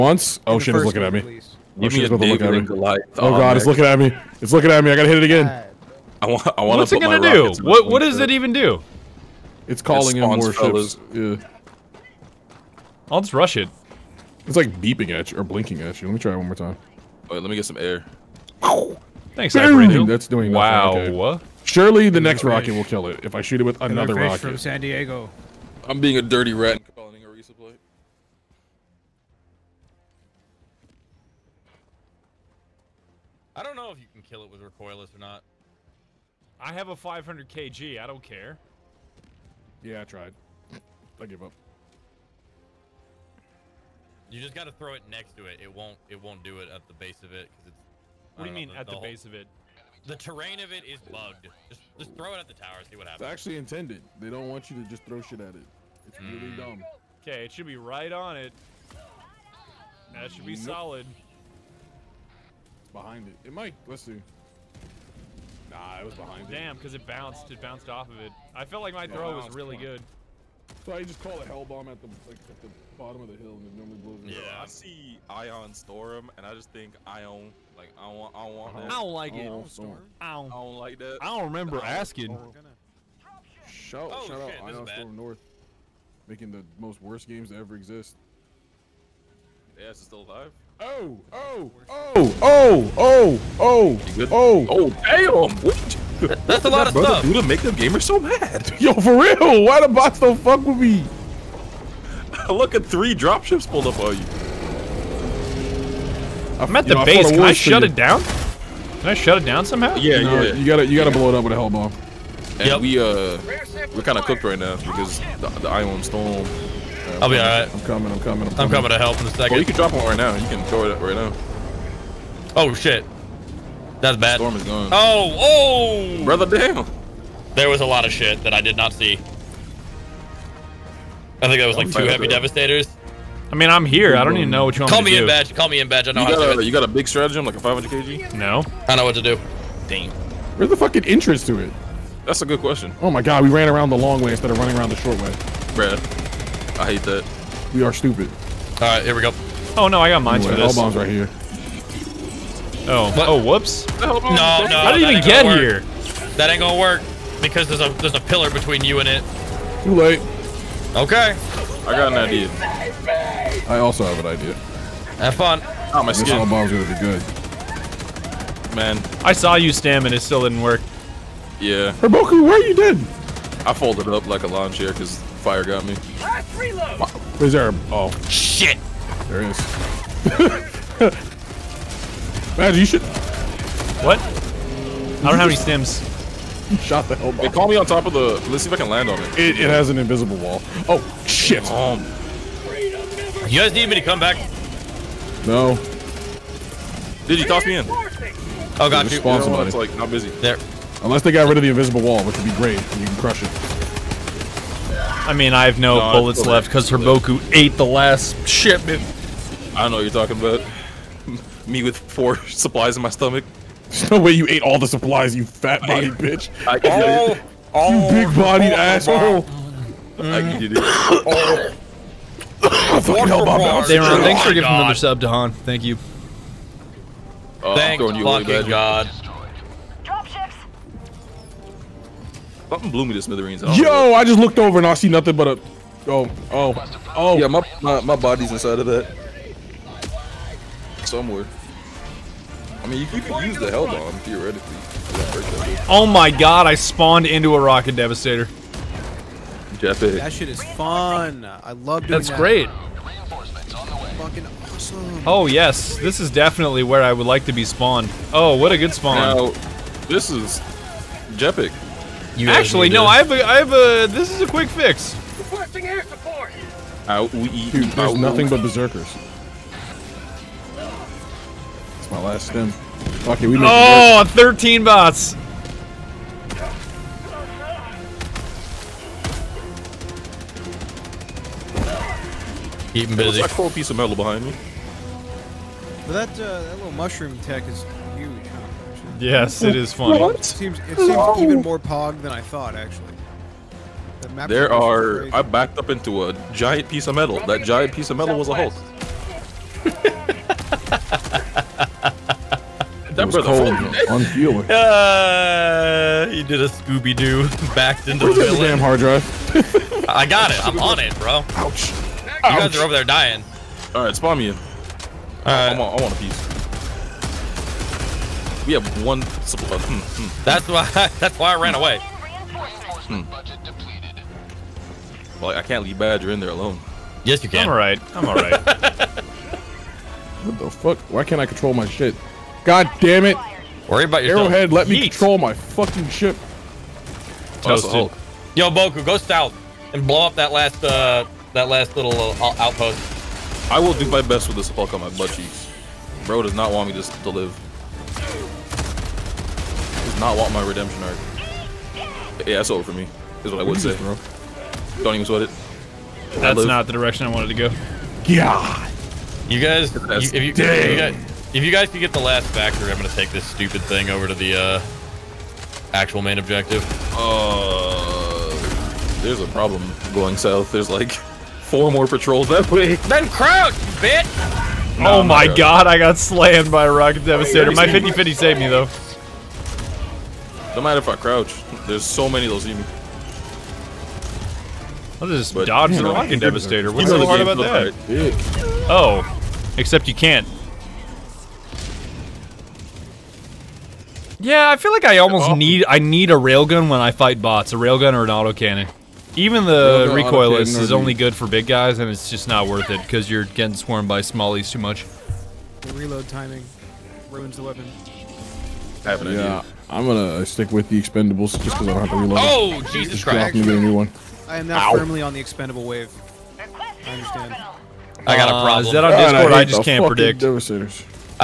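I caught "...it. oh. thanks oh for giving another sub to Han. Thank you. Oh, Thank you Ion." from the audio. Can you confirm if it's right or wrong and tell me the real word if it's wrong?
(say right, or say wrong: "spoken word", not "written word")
wrong: "God", not "Ion".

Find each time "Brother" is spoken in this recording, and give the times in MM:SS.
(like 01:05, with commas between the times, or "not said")
02:06.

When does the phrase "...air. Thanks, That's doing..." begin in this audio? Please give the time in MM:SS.
00:17.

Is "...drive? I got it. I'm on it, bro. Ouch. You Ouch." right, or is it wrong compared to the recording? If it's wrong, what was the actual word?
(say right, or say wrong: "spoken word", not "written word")
right.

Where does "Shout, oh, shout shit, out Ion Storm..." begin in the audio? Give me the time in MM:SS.
01:23.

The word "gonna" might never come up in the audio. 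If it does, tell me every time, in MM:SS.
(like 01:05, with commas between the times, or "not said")
00:07, 02:36, 02:46, 06:02, 06:50.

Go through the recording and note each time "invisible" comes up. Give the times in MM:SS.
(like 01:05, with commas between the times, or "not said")
03:09, 03:21.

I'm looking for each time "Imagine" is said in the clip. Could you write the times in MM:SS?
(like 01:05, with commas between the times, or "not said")
03:02.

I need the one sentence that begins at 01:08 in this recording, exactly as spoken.
I felt like my throw was really good.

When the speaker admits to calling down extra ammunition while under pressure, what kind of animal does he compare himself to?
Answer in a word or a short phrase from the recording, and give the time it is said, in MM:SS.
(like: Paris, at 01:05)
a dirty rat, at 00:26.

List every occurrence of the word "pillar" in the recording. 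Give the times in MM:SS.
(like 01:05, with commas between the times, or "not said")
02:38.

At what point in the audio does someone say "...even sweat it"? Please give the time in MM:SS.
05:55.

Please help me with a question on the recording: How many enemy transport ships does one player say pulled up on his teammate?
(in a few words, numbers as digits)
3.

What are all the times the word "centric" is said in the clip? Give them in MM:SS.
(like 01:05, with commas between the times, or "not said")
not said.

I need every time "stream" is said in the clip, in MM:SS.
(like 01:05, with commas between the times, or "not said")
not said.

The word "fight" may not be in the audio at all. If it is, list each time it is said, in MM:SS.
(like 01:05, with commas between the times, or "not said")
06:37.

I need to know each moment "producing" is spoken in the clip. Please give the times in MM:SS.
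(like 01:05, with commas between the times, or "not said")
not said.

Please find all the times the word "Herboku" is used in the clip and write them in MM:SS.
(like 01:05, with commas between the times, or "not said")
02:51, 03:26.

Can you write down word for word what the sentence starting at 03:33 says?
There's no way you ate all the supplies, you fat body bitch.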